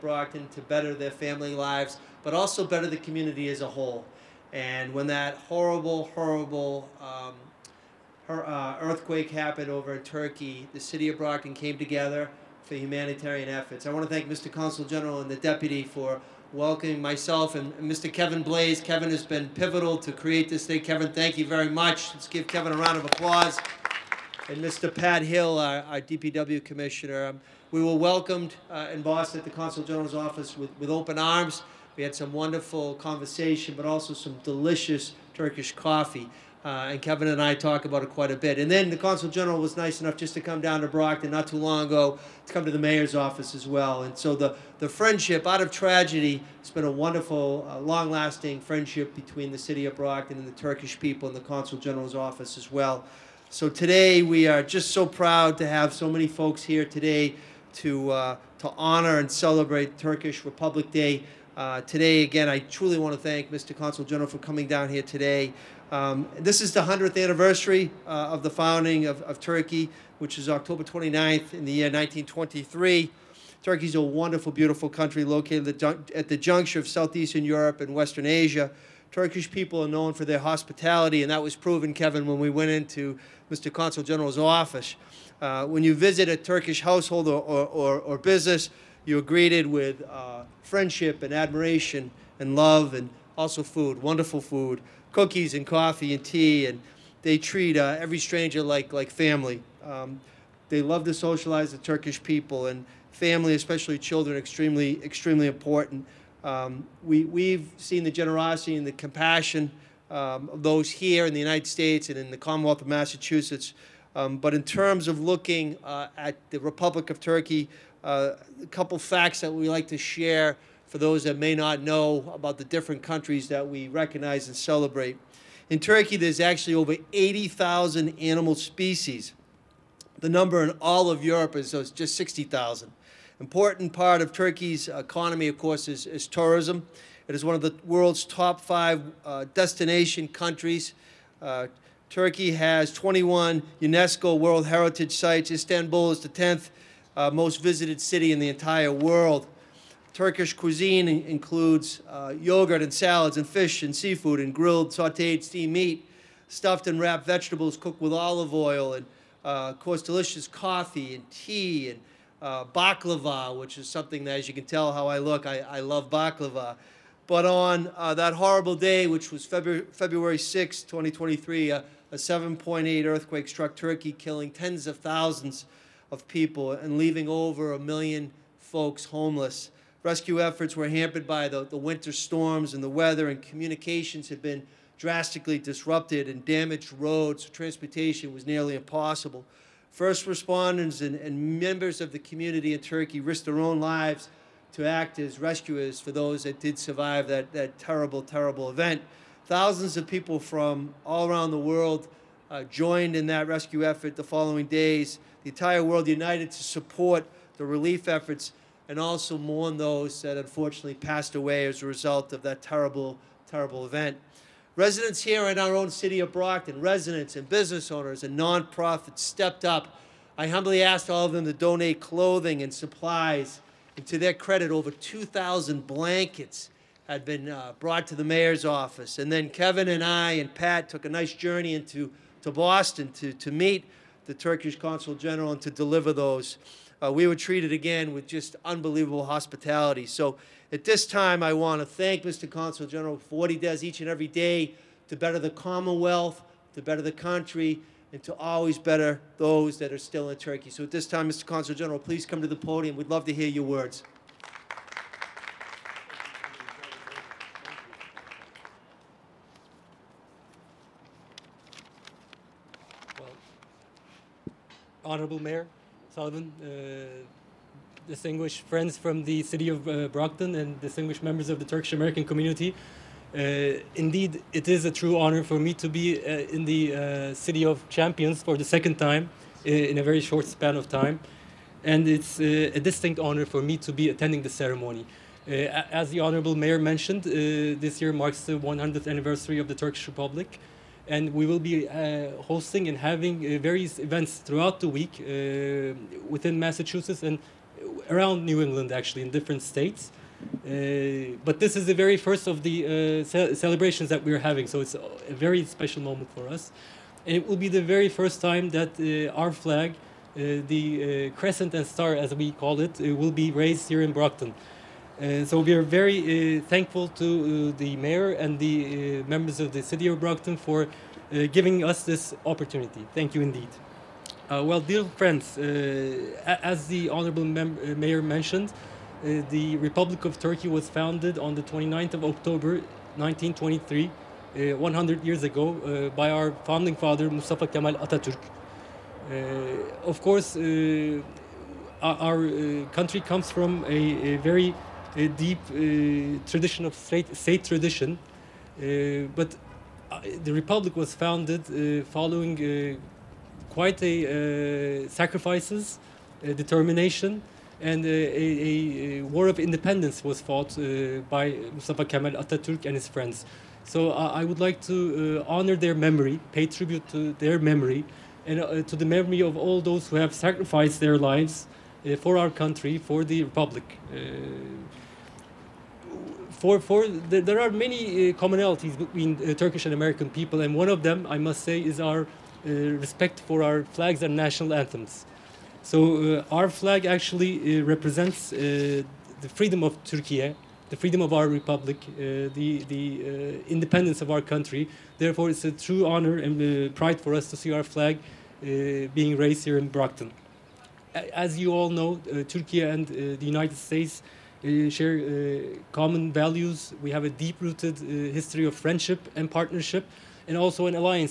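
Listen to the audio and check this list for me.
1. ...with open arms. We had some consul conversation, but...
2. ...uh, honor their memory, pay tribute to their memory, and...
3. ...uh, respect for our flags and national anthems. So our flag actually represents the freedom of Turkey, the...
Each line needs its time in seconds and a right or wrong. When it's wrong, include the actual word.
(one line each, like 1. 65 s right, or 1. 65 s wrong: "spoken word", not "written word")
1. 30 s wrong: "wonderful", not "consul"
2. 364 s right
3. 382 s right.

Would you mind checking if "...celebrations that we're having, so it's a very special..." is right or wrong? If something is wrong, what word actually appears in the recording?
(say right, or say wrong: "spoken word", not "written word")
right.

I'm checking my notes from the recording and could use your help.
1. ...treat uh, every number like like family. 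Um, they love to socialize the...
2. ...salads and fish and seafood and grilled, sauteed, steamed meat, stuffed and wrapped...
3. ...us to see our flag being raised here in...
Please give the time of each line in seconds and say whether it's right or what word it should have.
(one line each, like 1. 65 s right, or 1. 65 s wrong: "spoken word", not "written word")
1. 97 s wrong: "stranger", not "number"
2. 152 s right
3. 397 s right.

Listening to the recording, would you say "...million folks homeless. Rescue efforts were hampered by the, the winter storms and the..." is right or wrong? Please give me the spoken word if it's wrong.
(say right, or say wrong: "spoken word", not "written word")
right.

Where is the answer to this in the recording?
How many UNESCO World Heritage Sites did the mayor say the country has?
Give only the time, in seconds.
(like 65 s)
142 s.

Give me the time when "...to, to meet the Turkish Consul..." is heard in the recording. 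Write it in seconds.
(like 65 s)
233 s.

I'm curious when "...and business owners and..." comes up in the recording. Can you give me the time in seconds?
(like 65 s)
217 s.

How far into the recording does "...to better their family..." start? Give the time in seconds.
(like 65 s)
0 s.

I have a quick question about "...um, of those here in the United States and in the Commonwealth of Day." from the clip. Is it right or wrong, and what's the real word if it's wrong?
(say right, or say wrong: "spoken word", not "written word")
wrong: "Massachusetts", not "Day".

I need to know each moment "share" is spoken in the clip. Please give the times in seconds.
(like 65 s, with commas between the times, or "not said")
119 s, 404 s.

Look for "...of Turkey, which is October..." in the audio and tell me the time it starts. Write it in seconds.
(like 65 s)
69 s.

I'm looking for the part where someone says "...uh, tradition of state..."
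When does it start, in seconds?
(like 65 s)
345 s.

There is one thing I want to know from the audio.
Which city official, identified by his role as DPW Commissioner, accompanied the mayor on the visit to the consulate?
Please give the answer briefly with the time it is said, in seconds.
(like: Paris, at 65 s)
Pat Hill, at 24 s.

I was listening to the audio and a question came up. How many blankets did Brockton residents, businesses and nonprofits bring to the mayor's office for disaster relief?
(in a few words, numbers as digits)
2,000.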